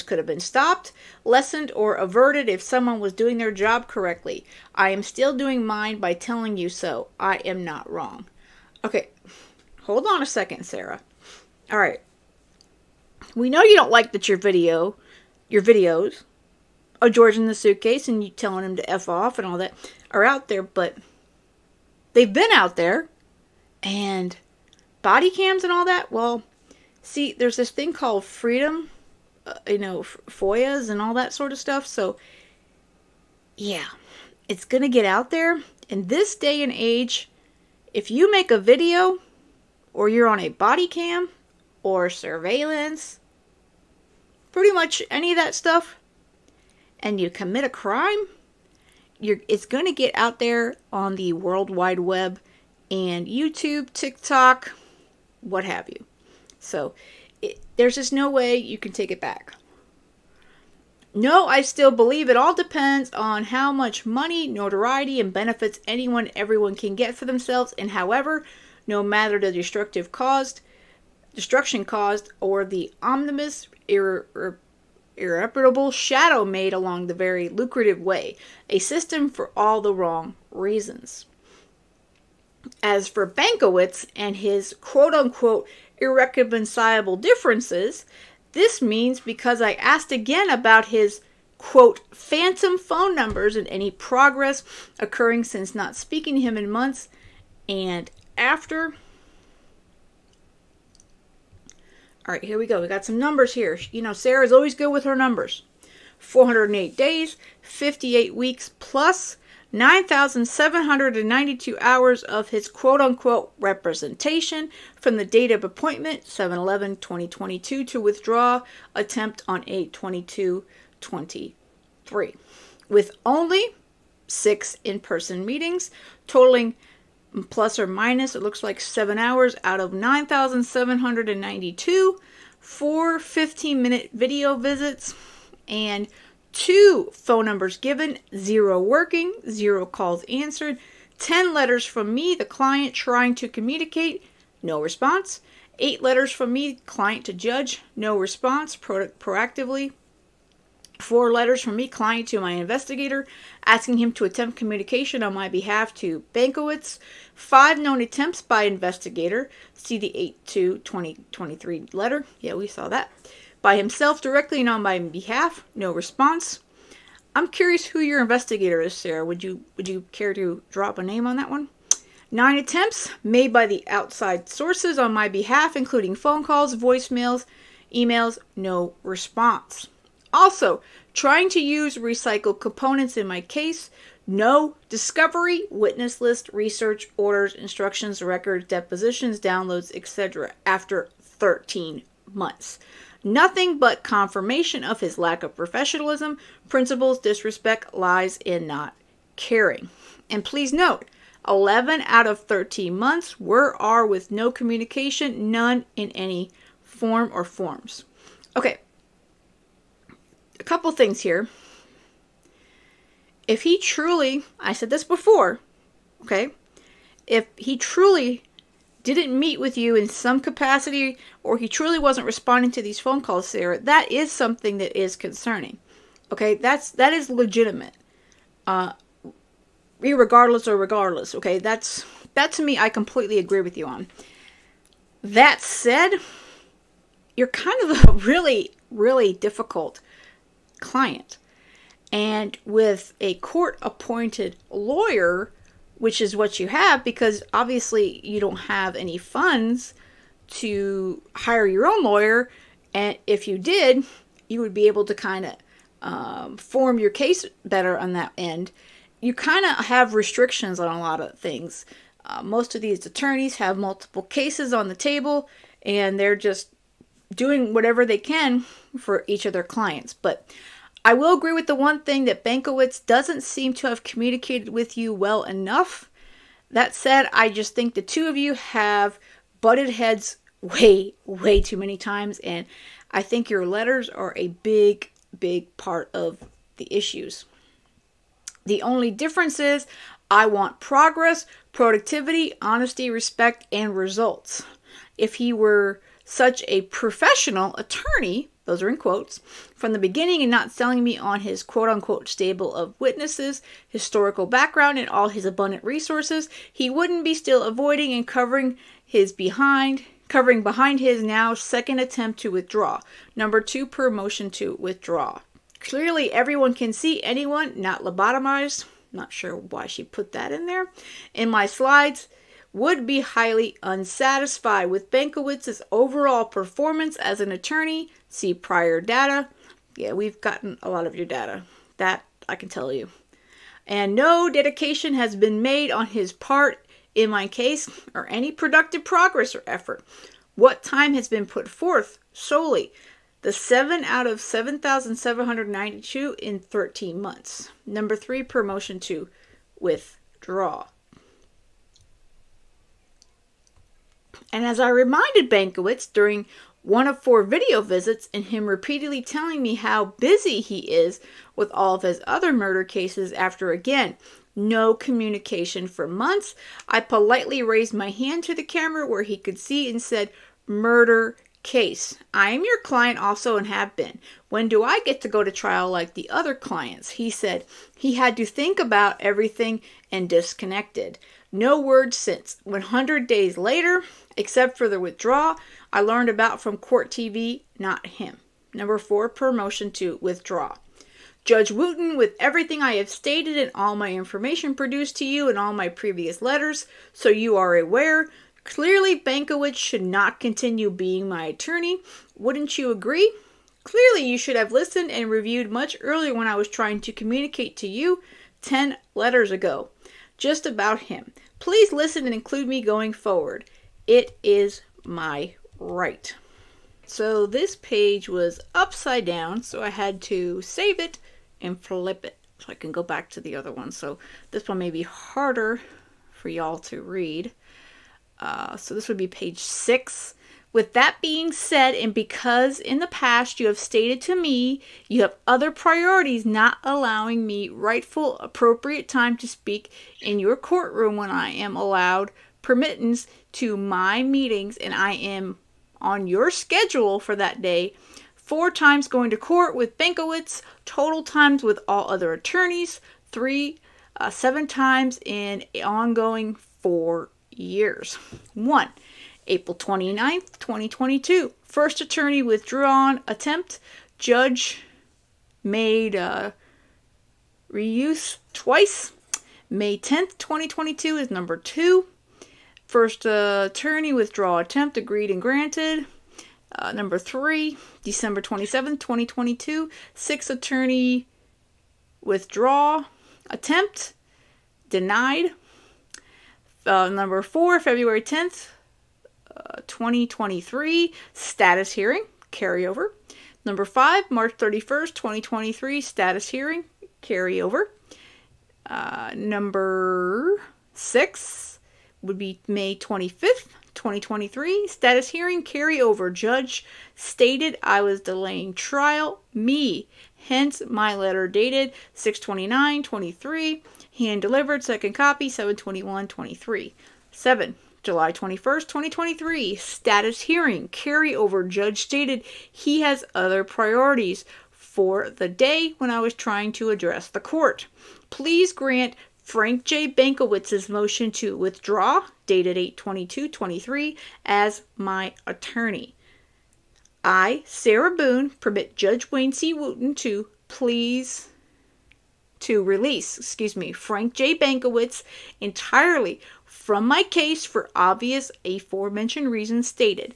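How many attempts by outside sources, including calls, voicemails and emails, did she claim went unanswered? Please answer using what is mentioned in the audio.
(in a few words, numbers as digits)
9.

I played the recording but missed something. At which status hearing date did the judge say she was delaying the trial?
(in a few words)
May 25, 2023.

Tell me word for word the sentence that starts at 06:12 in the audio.
I am your client also and have been.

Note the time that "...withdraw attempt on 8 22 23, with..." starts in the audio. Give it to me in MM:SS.
01:58.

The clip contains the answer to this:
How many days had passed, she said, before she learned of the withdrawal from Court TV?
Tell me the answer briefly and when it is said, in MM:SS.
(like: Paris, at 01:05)
100, at 06:22.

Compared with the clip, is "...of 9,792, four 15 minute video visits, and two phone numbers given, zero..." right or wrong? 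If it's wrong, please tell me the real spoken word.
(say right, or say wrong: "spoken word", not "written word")
right.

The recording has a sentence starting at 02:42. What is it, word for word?
Yeah, we saw that by himself directly and on my behalf.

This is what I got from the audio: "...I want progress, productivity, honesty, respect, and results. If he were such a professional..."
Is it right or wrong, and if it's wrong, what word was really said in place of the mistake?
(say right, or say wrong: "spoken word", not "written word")
right.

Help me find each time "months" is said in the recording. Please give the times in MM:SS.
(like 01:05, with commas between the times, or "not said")
01:36, 03:12, 03:22, 05:47, 06:06.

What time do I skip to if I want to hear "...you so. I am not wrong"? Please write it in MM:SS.
00:06.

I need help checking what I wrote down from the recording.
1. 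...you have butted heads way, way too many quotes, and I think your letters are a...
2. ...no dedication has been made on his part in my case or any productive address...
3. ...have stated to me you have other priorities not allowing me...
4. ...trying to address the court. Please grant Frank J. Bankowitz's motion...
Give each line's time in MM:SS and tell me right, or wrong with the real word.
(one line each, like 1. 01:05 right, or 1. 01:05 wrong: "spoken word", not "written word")
1. 04:38 wrong: "times", not "quotes"
2. 05:34 wrong: "progress", not "address"
3. 07:13 right
4. 08:46 right.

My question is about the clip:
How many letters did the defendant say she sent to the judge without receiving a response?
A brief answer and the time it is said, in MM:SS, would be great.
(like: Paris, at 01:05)
8, at 02:25.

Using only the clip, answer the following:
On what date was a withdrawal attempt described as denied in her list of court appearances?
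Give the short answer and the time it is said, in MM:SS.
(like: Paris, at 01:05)
December 27, 2022, at 07:58.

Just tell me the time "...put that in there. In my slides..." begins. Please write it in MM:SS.
05:20.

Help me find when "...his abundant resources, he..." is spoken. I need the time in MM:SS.
05:05.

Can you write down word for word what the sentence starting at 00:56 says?
So there's just no way you can take it back.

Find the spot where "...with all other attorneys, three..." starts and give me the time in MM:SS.
07:31.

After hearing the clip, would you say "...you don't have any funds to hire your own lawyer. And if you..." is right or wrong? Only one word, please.
right.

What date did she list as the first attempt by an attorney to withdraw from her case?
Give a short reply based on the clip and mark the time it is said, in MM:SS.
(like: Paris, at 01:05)
April 29, 2022, at 07:39.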